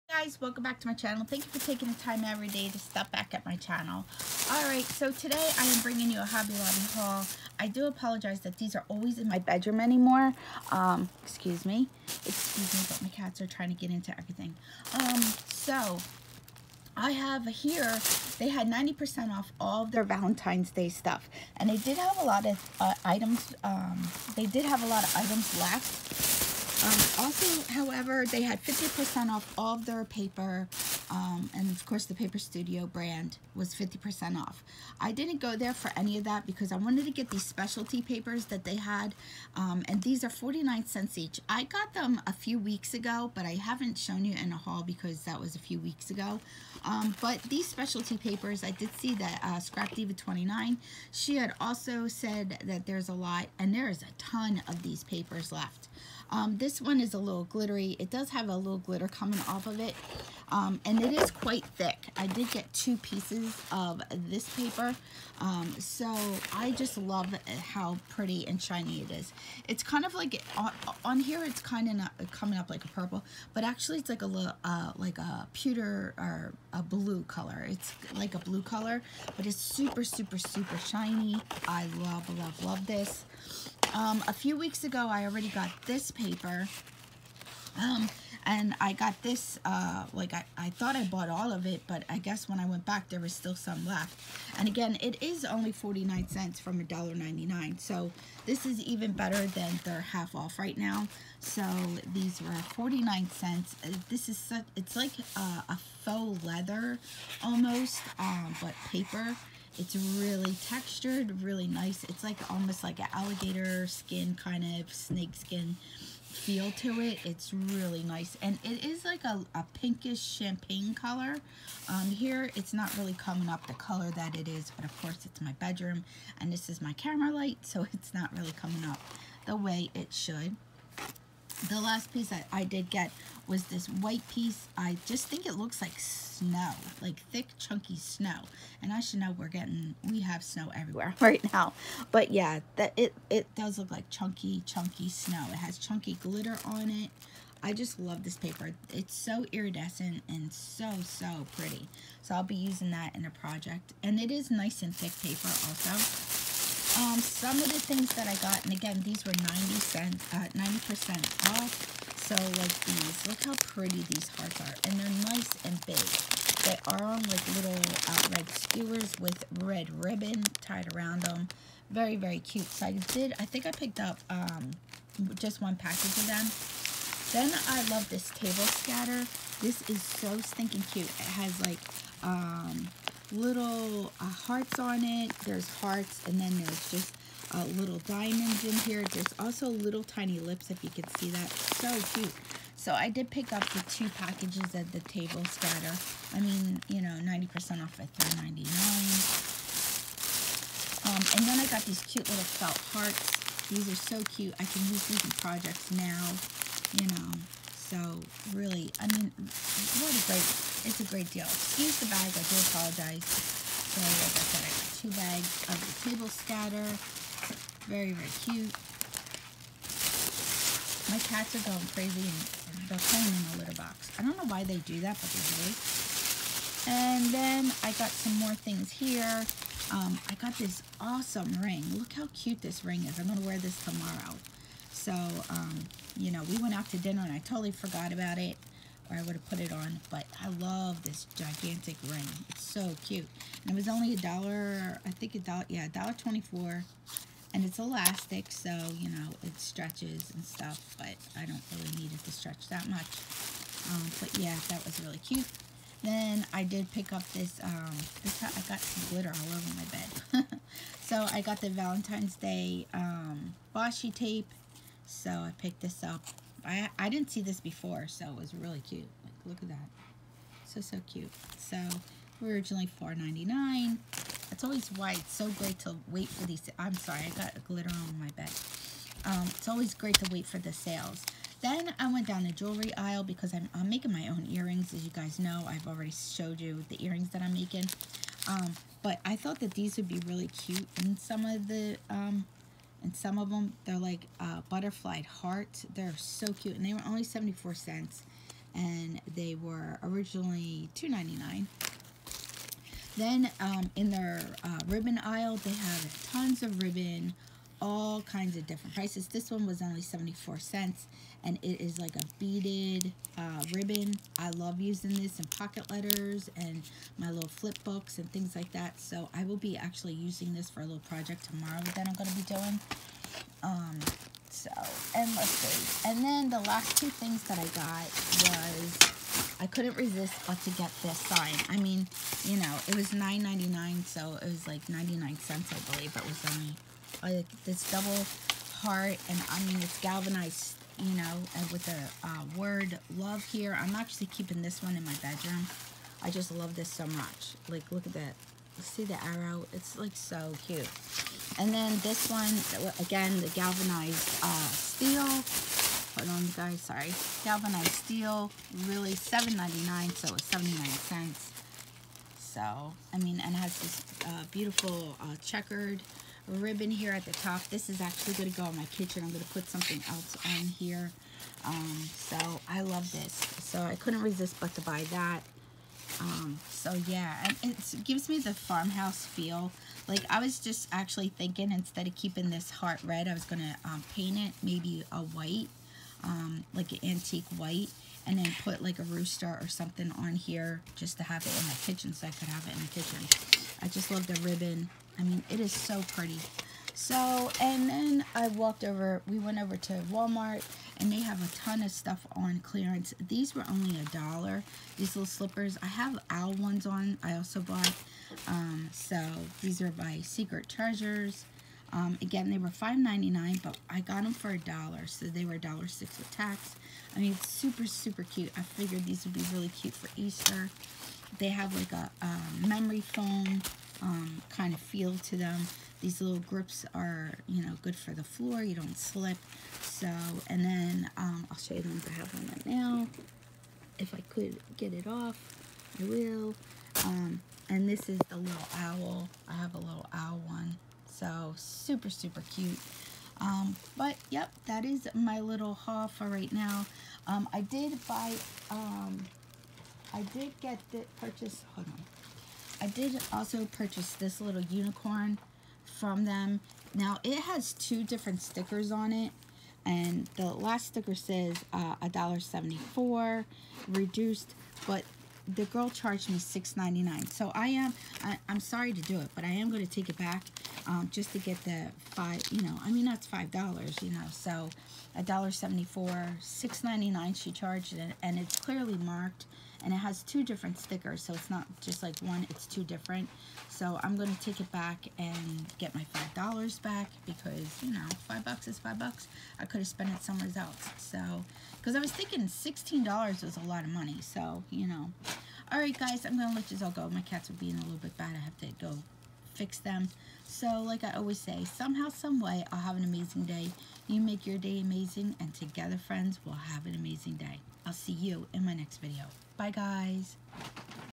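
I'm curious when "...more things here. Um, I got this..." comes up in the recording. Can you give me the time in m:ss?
3:48.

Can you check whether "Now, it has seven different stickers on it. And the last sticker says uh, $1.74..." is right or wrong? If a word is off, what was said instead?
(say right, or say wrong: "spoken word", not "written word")
wrong: "two", not "seven".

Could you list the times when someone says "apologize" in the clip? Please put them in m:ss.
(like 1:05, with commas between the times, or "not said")
0:07, 3:32.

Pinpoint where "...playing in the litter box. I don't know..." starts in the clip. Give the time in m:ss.
3:43.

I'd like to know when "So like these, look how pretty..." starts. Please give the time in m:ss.
2:42.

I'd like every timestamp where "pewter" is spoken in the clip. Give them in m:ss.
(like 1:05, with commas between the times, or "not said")
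1:15.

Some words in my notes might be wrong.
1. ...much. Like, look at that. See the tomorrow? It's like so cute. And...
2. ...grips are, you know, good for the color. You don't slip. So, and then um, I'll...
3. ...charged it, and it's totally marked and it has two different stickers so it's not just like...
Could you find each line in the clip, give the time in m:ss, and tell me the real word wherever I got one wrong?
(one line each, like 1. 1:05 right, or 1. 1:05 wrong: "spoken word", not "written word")
1. 5:47 wrong: "arrow", not "tomorrow"
2. 7:06 wrong: "floor", not "color"
3. 7:57 wrong: "clearly", not "totally".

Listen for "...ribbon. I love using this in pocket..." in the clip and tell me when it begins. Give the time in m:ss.
5:13.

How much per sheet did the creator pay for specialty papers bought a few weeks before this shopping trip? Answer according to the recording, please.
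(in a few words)
49 cents.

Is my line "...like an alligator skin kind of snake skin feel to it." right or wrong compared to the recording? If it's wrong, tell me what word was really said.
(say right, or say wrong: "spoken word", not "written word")
right.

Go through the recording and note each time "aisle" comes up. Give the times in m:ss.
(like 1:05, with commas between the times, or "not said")
4:42, 5:05.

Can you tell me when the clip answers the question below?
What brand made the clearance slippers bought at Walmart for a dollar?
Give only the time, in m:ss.
6:50.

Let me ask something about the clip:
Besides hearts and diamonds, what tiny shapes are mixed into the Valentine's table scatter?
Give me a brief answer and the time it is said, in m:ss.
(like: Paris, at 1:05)
Lips, at 3:09.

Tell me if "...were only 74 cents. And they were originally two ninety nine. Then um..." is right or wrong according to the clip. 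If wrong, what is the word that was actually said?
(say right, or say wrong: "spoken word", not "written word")
right.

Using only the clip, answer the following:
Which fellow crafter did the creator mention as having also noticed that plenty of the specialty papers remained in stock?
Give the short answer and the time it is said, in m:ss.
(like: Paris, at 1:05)
Scrap Diva 29, at 0:49.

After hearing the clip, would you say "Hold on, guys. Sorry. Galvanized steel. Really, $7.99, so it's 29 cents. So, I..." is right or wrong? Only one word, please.
wrong.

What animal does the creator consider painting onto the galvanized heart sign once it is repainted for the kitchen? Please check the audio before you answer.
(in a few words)
Rooster.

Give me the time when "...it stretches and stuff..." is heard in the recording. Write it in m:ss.
4:09.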